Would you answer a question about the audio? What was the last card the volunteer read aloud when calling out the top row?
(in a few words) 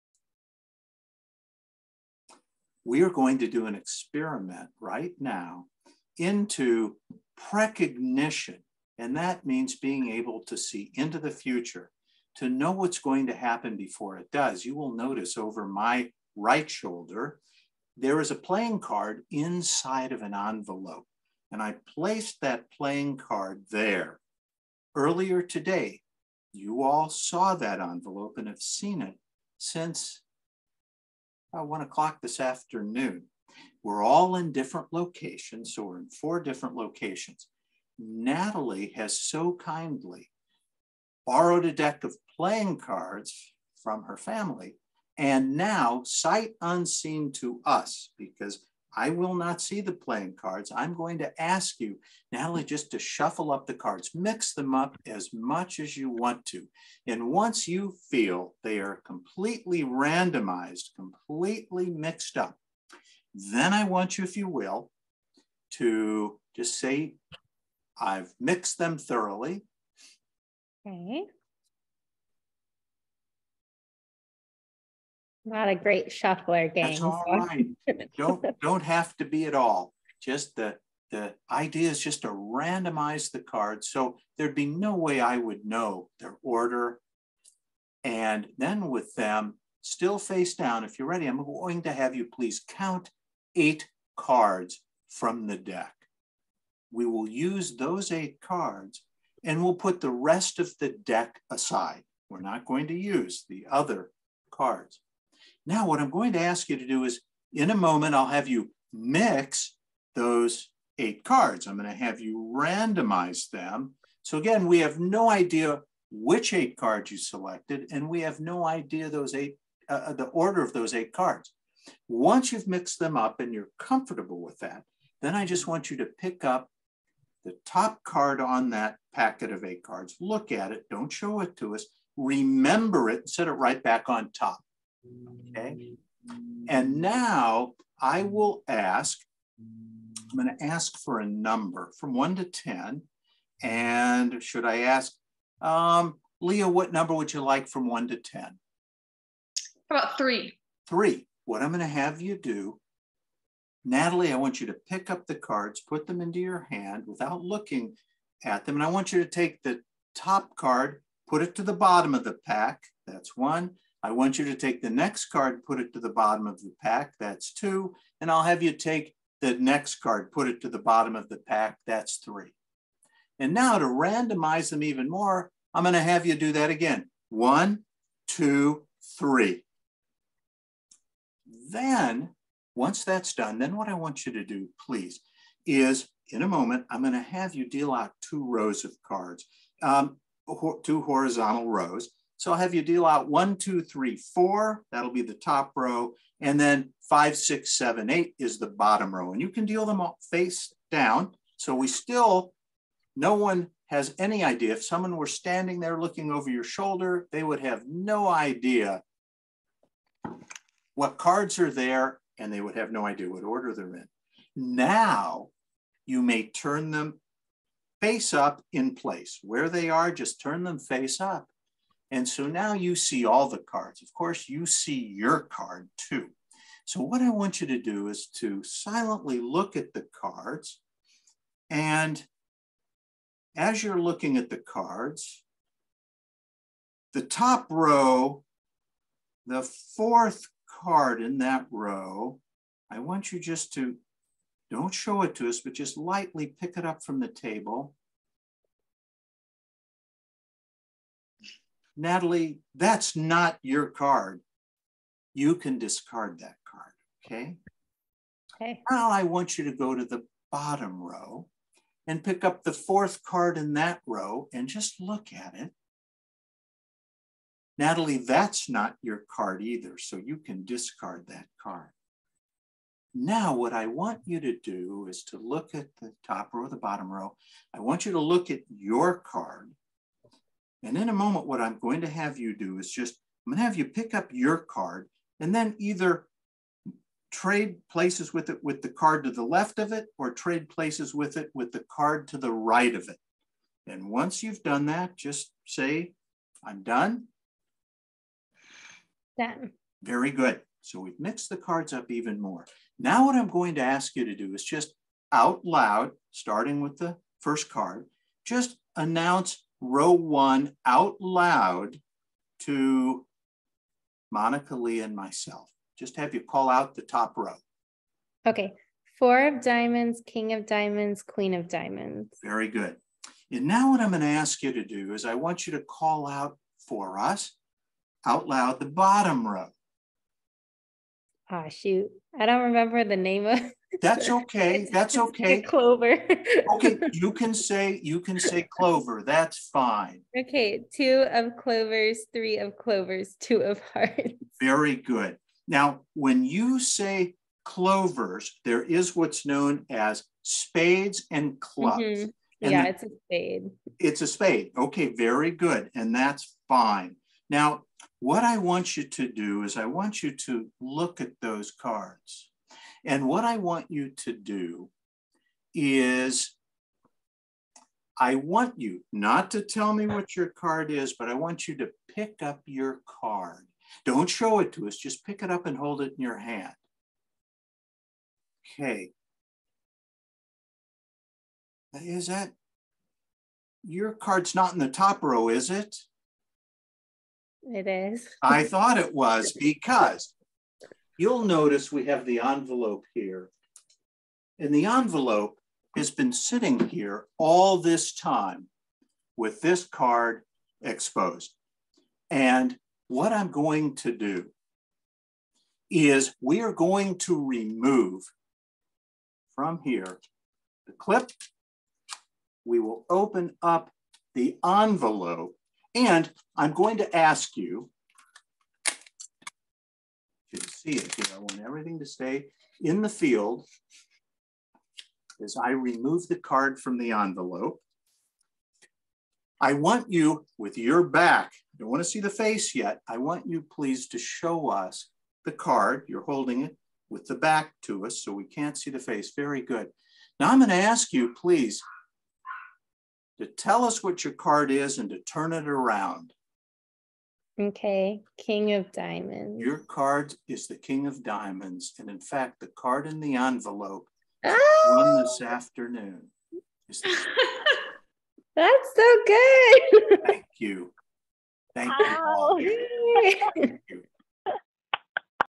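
Queen of diamonds.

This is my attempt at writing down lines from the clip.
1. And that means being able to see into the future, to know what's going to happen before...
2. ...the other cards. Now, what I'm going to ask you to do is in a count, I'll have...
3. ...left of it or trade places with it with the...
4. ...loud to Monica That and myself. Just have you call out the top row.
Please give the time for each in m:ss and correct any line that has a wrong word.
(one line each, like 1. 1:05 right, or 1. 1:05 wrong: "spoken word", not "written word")
1. 0:08 right
2. 1:43 wrong: "moment", not "count"
3. 4:49 right
4. 5:11 wrong: "Lee", not "That".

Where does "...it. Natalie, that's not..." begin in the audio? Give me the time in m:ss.
4:25.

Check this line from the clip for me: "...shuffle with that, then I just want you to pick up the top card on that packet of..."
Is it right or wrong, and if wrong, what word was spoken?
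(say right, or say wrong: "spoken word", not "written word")
wrong: "comfortable", not "shuffle".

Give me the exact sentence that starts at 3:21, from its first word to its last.
So we still, no one has any idea.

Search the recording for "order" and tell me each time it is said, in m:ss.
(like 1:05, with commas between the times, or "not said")
1:26, 2:00, 3:33.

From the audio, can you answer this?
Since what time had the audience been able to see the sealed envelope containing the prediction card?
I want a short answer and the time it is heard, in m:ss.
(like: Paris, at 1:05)
1:00 p.m., at 0:31.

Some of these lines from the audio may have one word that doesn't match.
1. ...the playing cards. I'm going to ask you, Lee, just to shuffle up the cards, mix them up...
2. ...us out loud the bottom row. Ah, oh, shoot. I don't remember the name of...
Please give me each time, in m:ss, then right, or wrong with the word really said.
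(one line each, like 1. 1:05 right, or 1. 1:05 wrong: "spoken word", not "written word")
1. 0:49 wrong: "Natalie", not "Lee"
2. 5:27 right.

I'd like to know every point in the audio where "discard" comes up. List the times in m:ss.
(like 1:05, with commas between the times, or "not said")
4:15, 4:30.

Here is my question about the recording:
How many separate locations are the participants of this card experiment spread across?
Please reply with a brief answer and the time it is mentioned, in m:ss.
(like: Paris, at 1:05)
4, at 0:36.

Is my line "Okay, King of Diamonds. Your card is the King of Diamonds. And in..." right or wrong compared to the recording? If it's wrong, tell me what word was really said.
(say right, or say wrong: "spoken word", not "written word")
right.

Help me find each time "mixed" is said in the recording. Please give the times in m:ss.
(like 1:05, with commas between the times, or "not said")
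1:01, 1:08, 2:02, 5:01.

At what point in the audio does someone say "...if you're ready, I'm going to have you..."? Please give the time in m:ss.
1:30.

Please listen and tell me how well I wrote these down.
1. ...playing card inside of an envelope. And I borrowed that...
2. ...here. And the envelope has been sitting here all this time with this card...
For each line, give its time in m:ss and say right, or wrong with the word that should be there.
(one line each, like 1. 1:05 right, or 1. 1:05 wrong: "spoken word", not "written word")
1. 0:18 wrong: "placed", not "borrowed"
2. 6:33 right.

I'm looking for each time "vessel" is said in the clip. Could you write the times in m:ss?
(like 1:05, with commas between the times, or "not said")
not said.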